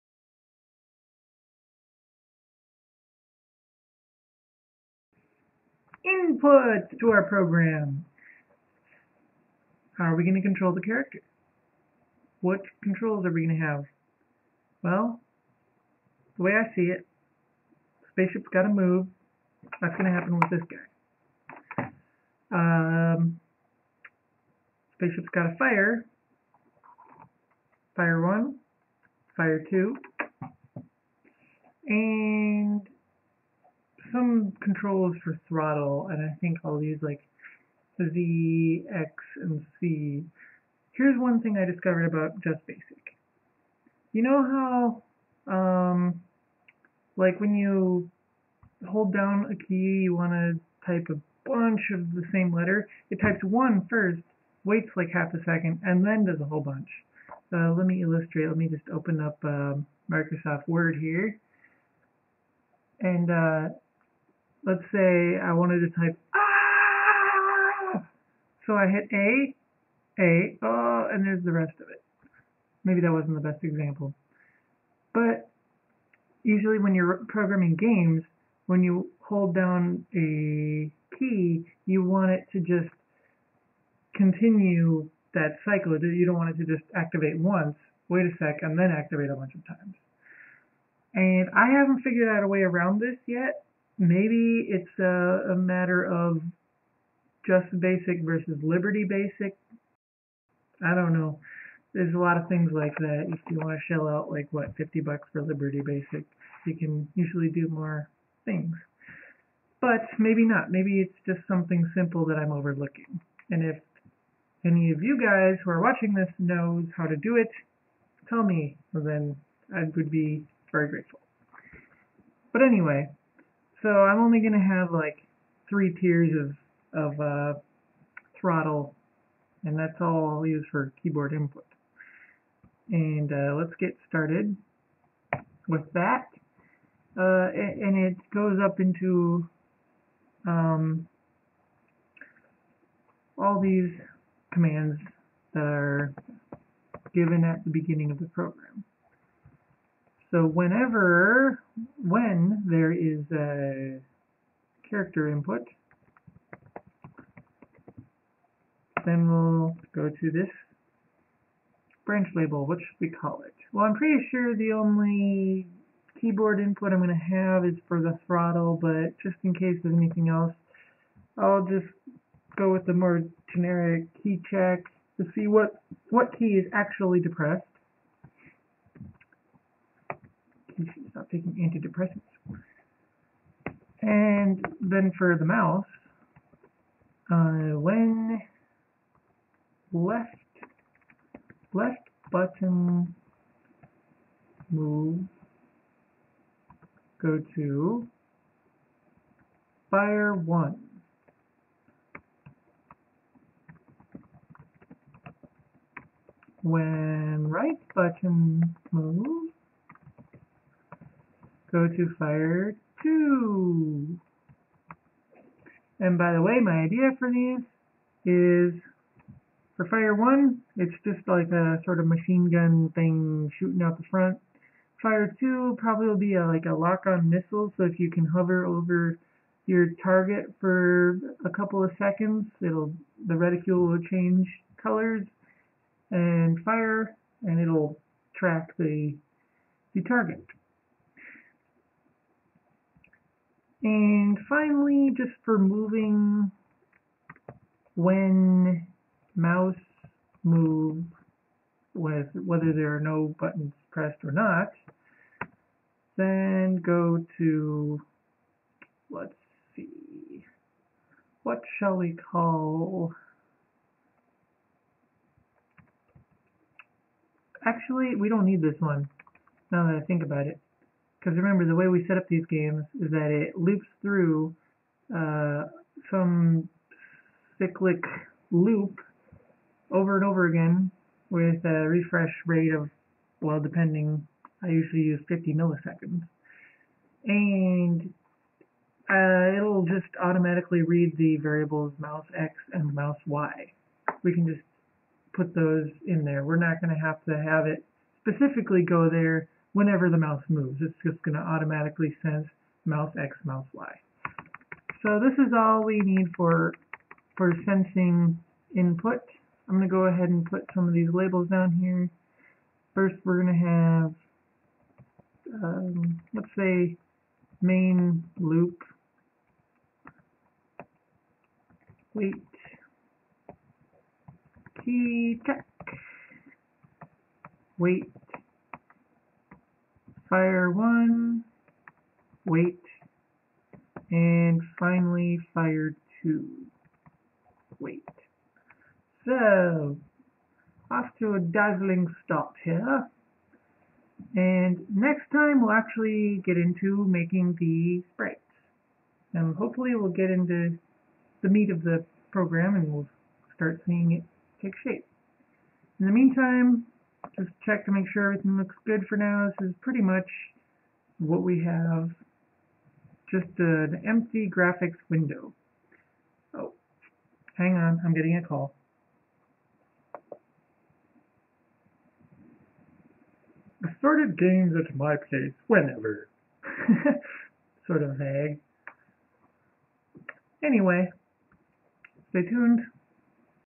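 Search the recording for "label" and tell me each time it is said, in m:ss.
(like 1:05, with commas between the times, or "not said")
2:42, 5:11.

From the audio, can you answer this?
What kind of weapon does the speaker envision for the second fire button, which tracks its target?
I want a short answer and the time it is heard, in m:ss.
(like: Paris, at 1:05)
lock-on missile, at 3:46.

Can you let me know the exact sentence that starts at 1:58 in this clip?
then I would be very grateful.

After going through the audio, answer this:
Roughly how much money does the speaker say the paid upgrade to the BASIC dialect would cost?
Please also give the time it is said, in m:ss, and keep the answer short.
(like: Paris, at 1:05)
50 bucks, at 1:44.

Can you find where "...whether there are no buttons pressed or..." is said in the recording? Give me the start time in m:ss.
4:12.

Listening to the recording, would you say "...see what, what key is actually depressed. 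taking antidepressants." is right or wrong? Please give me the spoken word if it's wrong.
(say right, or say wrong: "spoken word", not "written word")
right.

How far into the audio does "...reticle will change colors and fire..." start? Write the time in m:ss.
3:53.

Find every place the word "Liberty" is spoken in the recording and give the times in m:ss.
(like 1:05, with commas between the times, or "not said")
1:38, 1:45.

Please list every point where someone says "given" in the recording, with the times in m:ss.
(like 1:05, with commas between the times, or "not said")
2:27.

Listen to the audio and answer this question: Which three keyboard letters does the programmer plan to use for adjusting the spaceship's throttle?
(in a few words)
Z, X, and C.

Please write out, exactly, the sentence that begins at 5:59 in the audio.
This is pretty much what we have, just an empty graphics window.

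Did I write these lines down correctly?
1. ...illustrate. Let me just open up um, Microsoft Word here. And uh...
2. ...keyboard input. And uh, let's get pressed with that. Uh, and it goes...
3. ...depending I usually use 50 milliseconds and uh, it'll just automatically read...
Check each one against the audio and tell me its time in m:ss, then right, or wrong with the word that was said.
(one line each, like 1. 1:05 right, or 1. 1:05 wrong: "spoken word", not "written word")
1. 0:58 right
2. 2:11 wrong: "started", not "pressed"
3. 4:43 right.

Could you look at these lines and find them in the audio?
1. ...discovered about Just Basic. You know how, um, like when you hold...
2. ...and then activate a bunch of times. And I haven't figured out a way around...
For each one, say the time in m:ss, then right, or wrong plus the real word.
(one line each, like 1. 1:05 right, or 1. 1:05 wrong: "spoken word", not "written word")
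1. 0:41 right
2. 1:28 right.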